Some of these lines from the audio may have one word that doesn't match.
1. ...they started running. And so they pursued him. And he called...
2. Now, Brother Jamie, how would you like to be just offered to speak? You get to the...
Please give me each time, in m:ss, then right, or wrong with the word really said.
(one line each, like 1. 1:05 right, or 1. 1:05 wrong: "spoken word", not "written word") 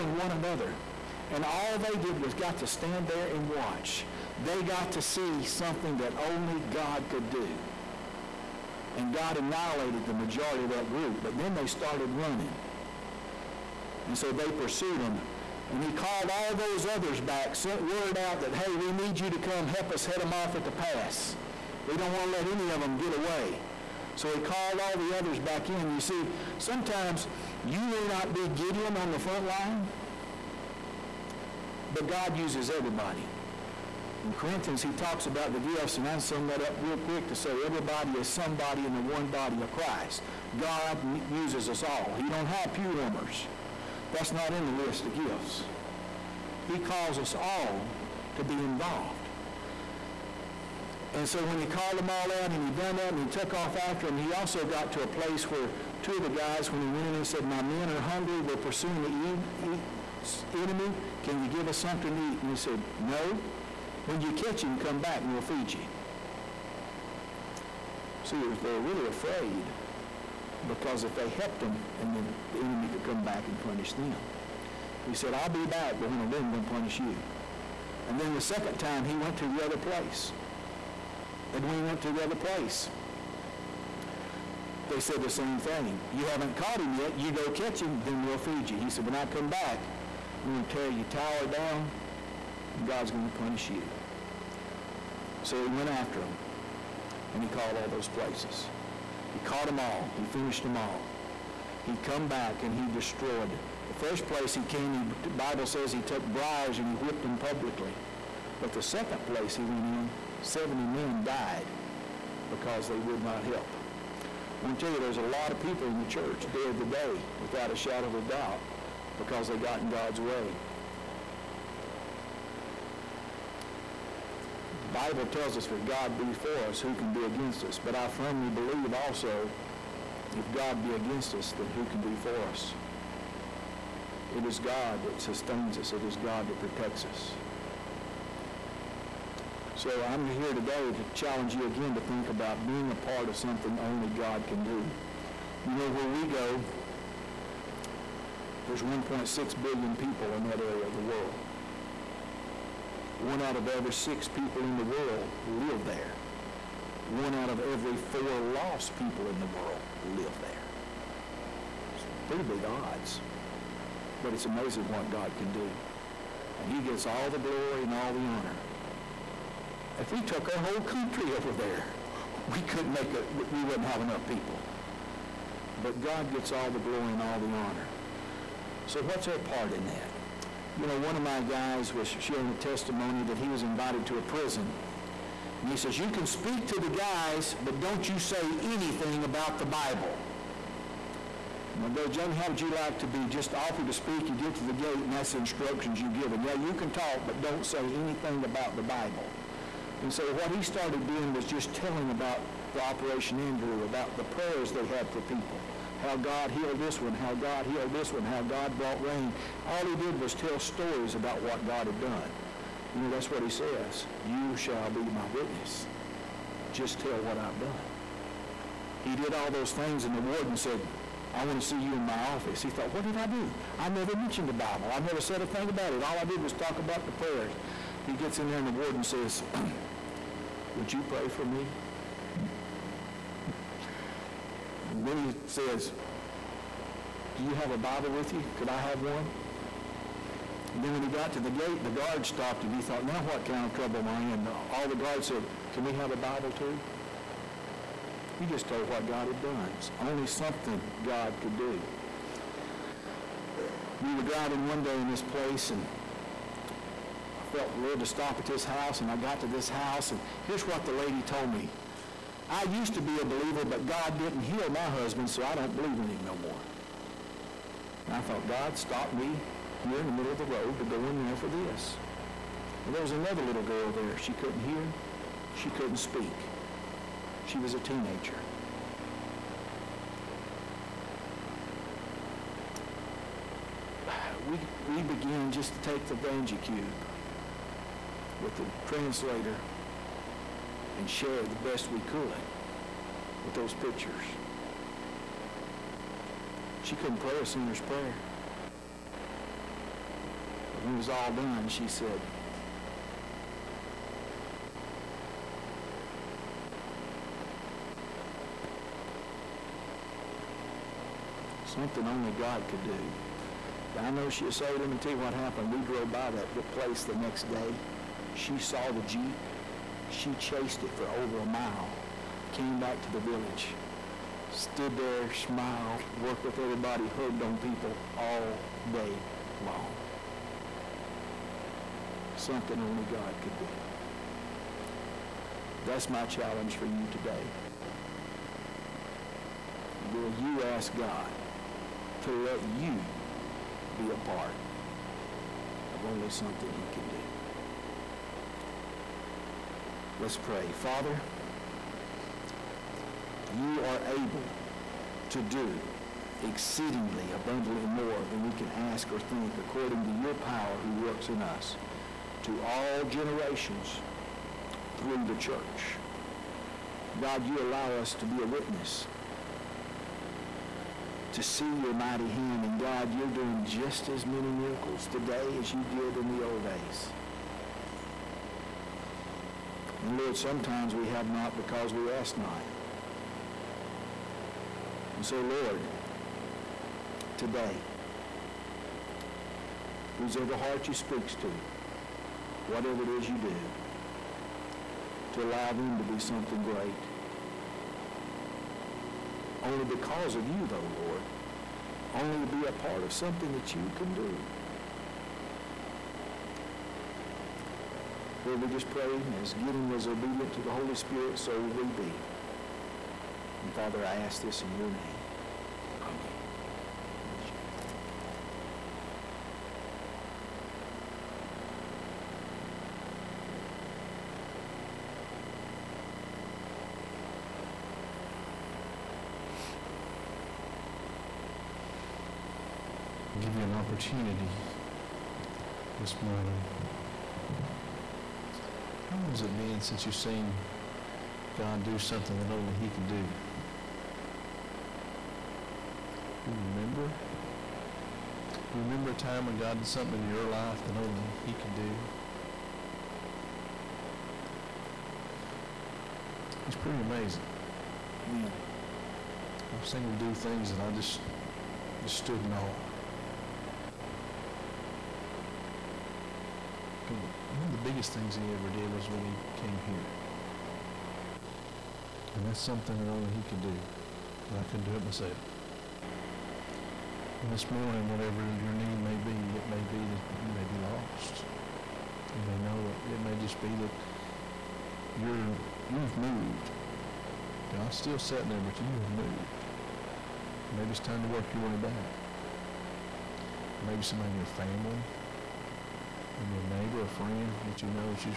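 1. 0:11 right
2. 3:11 right.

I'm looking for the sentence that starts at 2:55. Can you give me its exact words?
But God gets all the glory and all the honor.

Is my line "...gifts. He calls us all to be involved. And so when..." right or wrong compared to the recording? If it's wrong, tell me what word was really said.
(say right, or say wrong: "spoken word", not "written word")
right.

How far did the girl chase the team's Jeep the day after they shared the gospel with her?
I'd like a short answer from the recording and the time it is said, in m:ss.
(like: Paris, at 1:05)
over a mile, at 5:21.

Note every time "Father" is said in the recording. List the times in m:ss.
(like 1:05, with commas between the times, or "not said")
5:50, 6:53.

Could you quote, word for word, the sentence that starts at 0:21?
We don't want to let any of them get away.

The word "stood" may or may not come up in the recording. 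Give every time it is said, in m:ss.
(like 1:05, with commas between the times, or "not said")
5:24, 7:42.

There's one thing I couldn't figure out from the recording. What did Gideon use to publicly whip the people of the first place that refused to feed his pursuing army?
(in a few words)
briars.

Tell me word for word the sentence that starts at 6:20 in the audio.
And Lord, sometimes we have not because we ask not.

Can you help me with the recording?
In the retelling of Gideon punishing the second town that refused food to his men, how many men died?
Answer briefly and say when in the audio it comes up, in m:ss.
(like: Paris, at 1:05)
70, at 1:50.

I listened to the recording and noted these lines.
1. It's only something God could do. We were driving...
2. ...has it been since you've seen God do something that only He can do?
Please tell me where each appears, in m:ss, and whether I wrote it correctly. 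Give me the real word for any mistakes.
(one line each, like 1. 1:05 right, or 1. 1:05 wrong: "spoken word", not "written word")
1. 4:09 right
2. 7:19 right.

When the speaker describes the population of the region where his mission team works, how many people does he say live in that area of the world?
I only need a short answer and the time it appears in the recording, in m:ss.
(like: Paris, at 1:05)
1.6 billion, at 2:28.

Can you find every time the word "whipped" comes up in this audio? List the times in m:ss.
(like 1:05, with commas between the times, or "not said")
1:46.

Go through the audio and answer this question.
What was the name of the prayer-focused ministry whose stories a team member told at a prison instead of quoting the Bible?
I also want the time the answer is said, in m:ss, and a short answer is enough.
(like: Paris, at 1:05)
Operation Andrew, at 3:22.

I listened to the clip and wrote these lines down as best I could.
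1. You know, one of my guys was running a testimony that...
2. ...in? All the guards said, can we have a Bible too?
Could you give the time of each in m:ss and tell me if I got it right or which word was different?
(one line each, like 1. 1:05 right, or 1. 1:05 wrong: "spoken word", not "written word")
1. 3:00 wrong: "sharing", not "running"
2. 4:04 right.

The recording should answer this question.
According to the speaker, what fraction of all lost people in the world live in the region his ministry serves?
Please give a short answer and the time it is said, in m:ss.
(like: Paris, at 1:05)
One out of every four, at 2:37.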